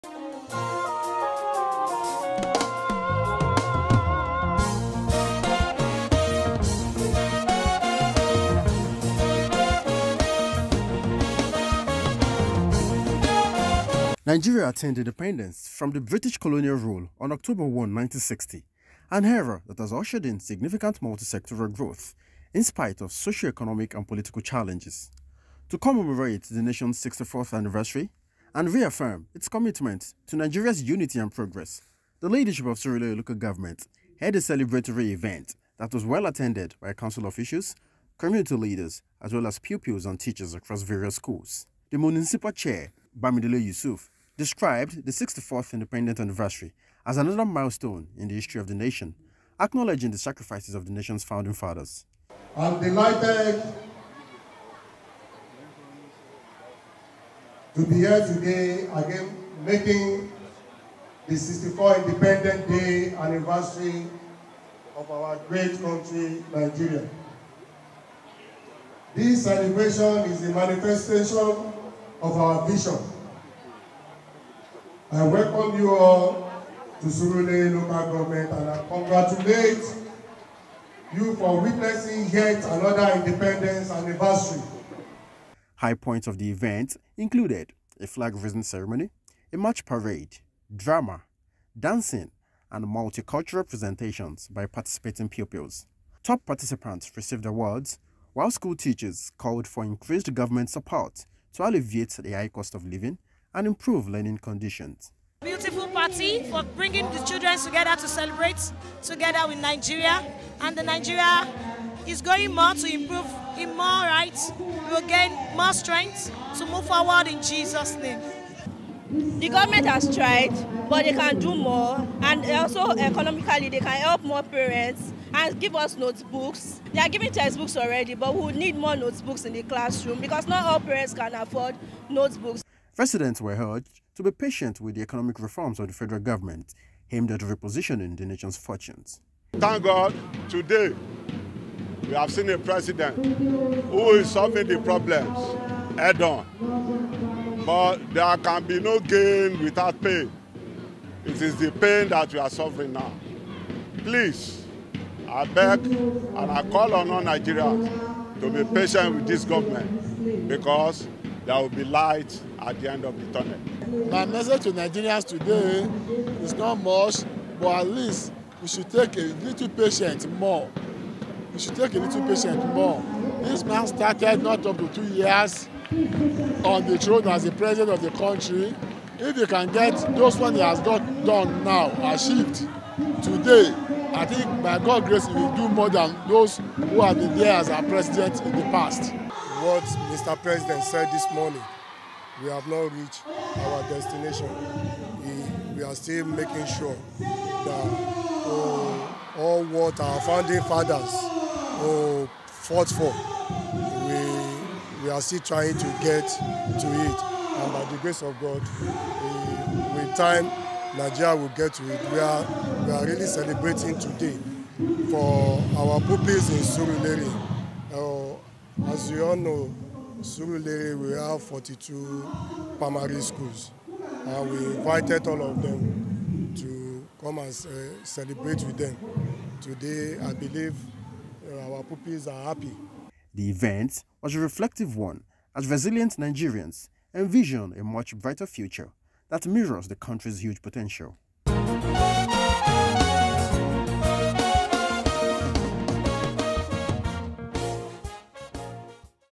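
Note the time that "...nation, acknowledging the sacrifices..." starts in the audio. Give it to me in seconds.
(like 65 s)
48 s.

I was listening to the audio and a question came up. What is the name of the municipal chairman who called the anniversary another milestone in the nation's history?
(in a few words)
Bamidele Yusuf.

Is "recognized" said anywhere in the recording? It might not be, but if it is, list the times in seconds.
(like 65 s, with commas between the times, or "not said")
not said.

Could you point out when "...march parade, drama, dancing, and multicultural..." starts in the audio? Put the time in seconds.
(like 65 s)
89 s.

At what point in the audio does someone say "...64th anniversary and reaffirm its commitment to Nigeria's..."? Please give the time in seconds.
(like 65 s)
27 s.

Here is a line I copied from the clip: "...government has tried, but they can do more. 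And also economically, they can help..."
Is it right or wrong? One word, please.
right.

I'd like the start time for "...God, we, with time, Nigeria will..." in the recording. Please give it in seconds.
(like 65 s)
208 s.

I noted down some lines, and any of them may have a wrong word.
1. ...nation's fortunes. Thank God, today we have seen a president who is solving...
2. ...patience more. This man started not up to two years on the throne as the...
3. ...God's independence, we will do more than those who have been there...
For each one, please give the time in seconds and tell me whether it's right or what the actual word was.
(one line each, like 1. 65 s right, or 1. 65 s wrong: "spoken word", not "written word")
1. 138 s right
2. 172 s right
3. 184 s wrong: "grace", not "independence".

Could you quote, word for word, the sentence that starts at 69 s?
This celebration is a manifestation of our vision.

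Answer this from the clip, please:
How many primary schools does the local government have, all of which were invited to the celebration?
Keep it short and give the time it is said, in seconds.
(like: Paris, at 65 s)
42, at 221 s.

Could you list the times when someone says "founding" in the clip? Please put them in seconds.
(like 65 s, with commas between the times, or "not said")
51 s, 200 s.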